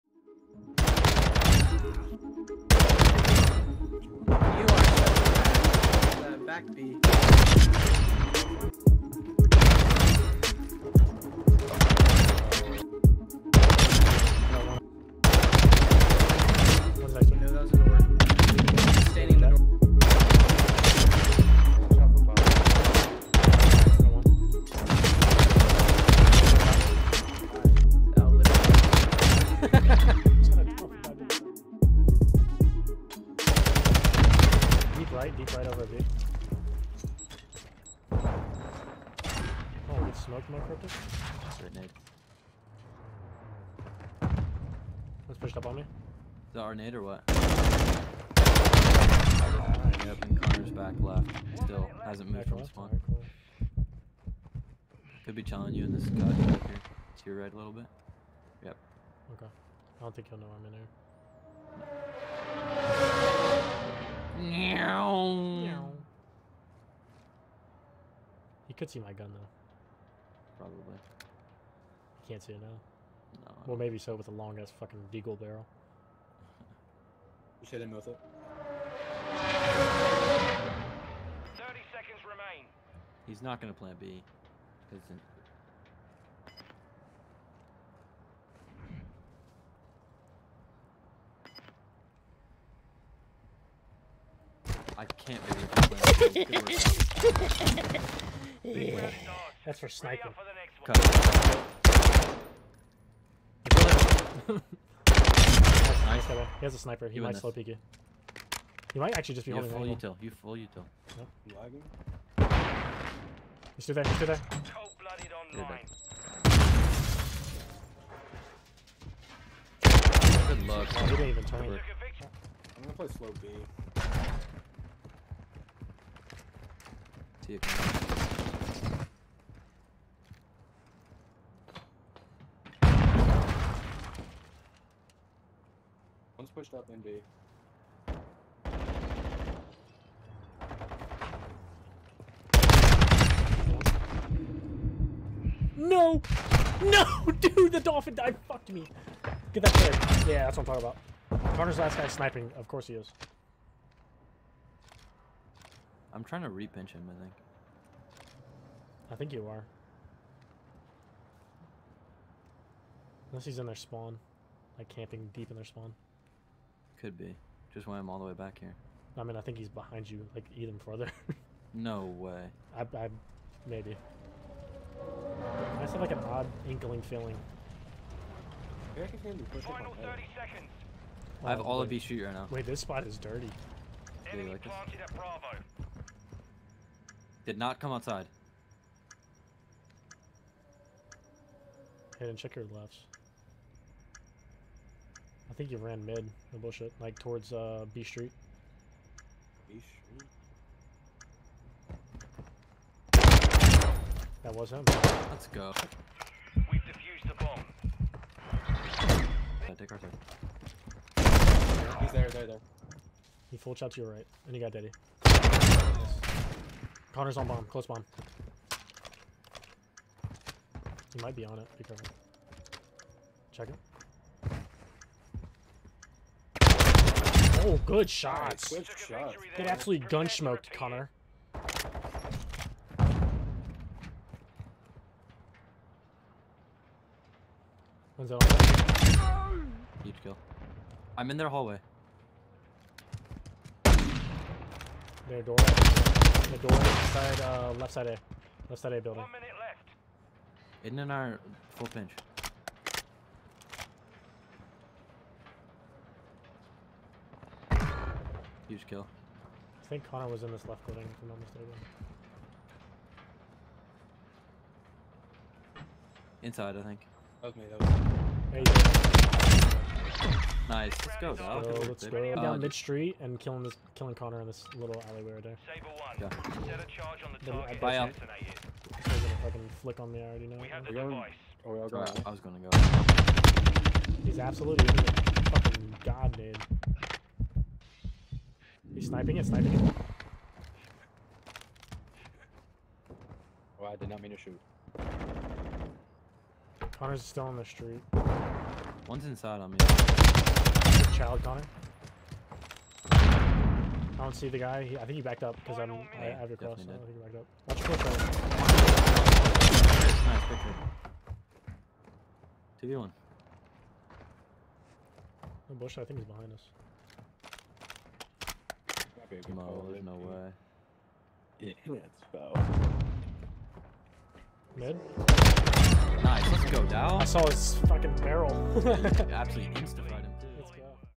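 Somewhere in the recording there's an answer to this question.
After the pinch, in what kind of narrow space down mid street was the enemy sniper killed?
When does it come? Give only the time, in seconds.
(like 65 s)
275 s.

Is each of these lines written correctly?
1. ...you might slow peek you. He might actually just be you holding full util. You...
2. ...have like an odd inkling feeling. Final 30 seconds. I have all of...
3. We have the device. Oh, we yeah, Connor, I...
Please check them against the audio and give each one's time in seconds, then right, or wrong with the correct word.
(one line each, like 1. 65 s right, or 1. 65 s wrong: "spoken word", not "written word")
1. 107 s right
2. 175 s right
3. 280 s wrong: "Sorry", not "Connor".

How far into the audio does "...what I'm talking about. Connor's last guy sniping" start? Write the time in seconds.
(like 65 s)
150 s.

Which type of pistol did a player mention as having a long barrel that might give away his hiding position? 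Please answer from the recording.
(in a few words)
Deagle.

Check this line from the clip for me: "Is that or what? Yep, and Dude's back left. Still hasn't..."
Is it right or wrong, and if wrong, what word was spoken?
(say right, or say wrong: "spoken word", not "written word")
wrong: "Connor", not "Dude".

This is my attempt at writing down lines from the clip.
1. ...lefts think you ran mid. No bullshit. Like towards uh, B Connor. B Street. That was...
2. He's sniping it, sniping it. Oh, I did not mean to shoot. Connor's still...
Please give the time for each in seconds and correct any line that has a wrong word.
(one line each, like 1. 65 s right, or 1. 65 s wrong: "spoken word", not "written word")
1. 192 s wrong: "Street", not "Connor"
2. 288 s right.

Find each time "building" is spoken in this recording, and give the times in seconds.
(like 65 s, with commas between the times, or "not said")
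249 s, 260 s.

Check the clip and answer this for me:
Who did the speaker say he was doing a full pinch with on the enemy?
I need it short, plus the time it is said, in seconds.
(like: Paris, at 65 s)
Aiden, at 250 s.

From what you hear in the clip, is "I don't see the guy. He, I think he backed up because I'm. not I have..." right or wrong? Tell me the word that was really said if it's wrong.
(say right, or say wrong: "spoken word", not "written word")
right.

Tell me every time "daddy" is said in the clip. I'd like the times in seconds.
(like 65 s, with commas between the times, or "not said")
214 s.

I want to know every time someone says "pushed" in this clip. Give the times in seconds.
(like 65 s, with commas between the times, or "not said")
45 s, 136 s.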